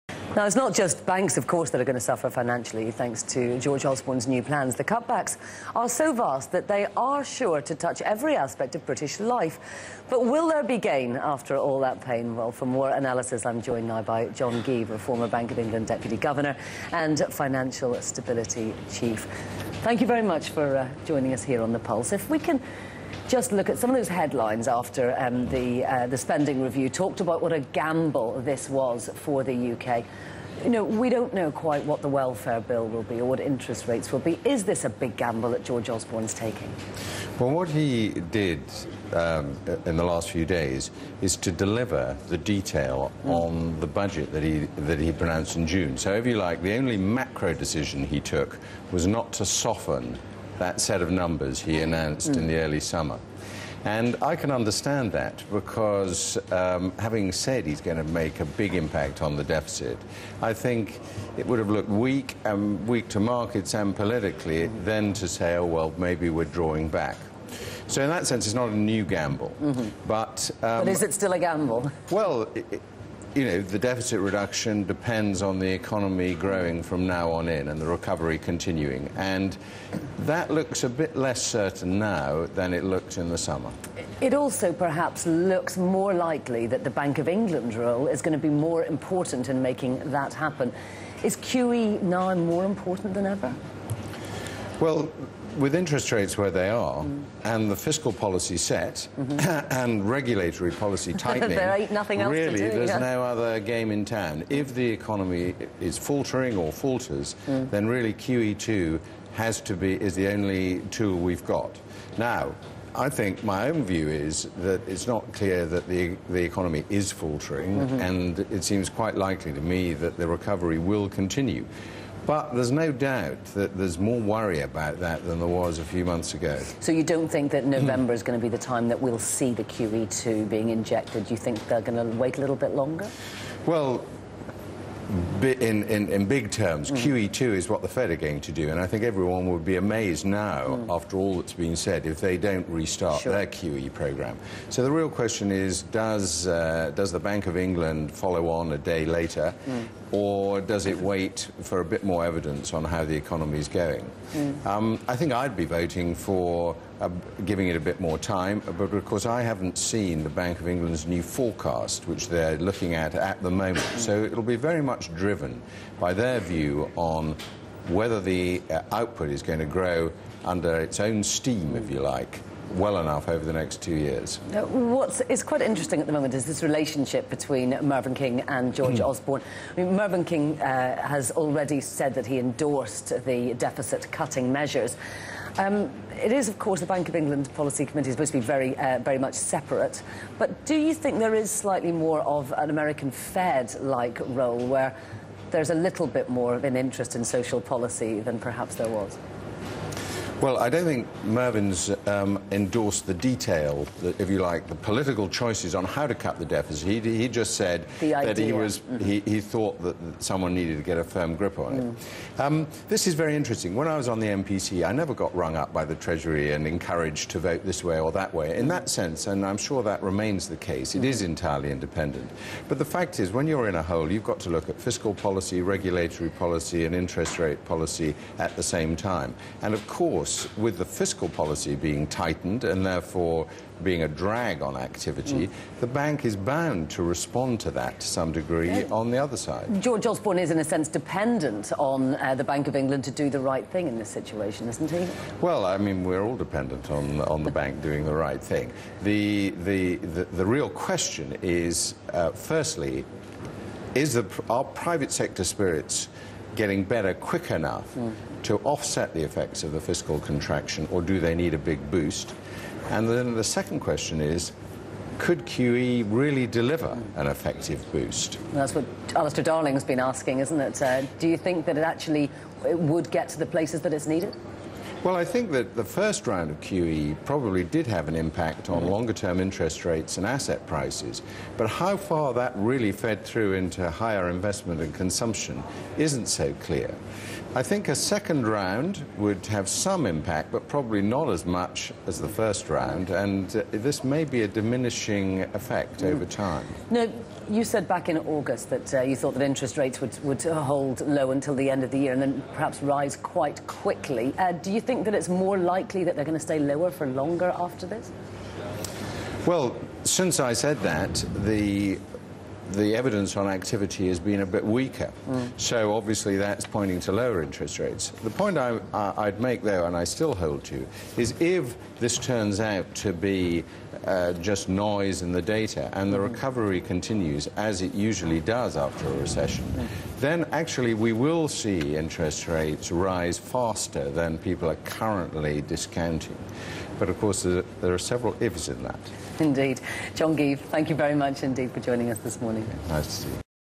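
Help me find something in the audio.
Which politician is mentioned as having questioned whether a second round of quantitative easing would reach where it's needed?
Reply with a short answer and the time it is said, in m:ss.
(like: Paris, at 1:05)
Alistair Darling, at 4:29.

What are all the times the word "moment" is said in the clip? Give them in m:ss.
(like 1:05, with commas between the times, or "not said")
2:43, 2:56.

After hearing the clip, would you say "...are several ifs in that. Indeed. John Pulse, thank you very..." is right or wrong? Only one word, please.
wrong.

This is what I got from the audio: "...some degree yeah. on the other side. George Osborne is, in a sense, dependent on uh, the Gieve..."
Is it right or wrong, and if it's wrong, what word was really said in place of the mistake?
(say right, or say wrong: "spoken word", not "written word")
wrong: "Bank", not "Gieve".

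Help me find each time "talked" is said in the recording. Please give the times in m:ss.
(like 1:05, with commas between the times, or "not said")
0:26.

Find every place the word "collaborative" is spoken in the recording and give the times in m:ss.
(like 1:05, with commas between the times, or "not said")
not said.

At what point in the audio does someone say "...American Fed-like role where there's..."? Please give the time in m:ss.
3:12.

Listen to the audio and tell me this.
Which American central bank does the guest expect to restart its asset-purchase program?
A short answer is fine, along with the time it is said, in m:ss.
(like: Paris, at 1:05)
the Fed, at 2:17.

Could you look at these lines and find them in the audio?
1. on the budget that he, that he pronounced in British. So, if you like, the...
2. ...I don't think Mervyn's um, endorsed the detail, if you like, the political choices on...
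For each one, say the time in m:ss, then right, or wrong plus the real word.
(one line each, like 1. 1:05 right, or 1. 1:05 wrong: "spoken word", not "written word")
1. 0:43 wrong: "June", not "British"
2. 3:20 right.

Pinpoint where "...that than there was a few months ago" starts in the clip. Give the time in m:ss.
2:04.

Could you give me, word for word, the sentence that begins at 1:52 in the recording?
Now, I think my own view is that it's not clear that the, the economy is faltering, mm -hmm.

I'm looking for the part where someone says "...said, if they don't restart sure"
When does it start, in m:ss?
2:21.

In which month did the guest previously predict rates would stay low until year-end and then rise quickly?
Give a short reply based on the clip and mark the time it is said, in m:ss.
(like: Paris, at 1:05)
August, at 4:58.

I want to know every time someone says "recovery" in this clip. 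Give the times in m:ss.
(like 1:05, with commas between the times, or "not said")
1:17, 2:00, 5:26.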